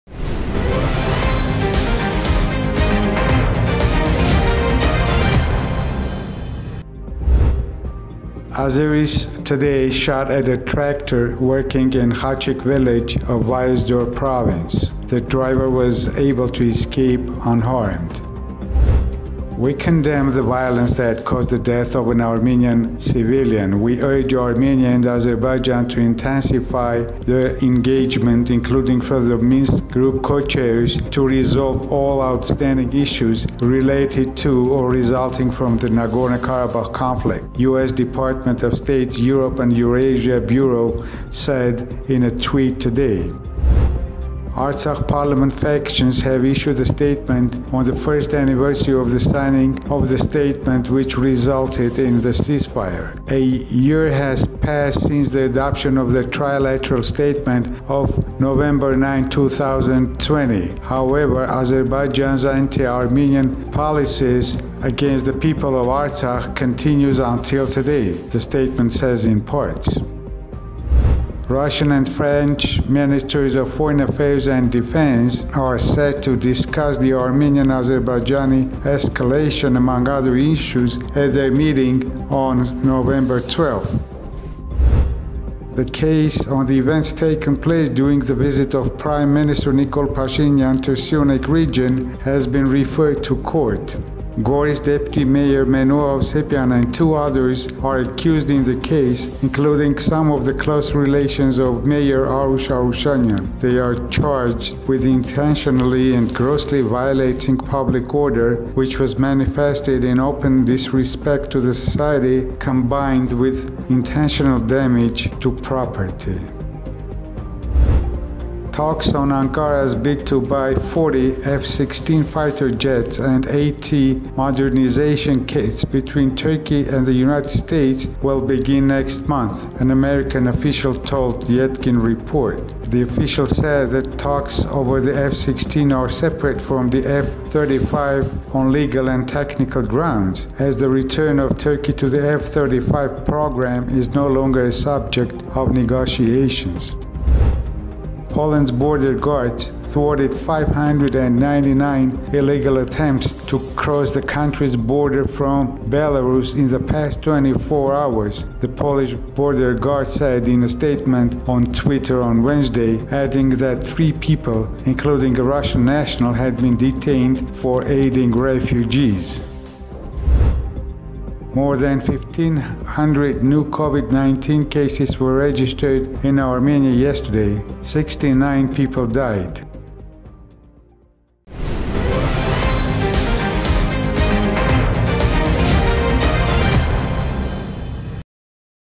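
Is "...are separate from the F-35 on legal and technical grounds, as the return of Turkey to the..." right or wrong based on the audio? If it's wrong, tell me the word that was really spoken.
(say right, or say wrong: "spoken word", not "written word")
right.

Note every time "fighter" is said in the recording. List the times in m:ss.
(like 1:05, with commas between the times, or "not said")
2:02.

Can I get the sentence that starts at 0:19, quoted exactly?
We condemn the violence that caused the death of an Armenian civilian.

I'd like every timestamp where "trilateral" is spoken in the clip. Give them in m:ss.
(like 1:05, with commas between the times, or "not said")
0:56.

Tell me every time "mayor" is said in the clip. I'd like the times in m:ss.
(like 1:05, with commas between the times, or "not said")
1:35, 1:41.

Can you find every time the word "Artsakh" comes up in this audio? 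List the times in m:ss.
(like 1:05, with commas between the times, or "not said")
0:44, 1:05.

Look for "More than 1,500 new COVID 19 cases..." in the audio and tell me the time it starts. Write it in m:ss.
2:51.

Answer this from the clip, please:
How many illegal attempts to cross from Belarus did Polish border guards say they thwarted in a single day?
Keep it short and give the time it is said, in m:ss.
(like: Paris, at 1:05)
599, at 2:30.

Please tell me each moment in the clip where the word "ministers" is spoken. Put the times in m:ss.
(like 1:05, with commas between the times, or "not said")
1:12, 1:29.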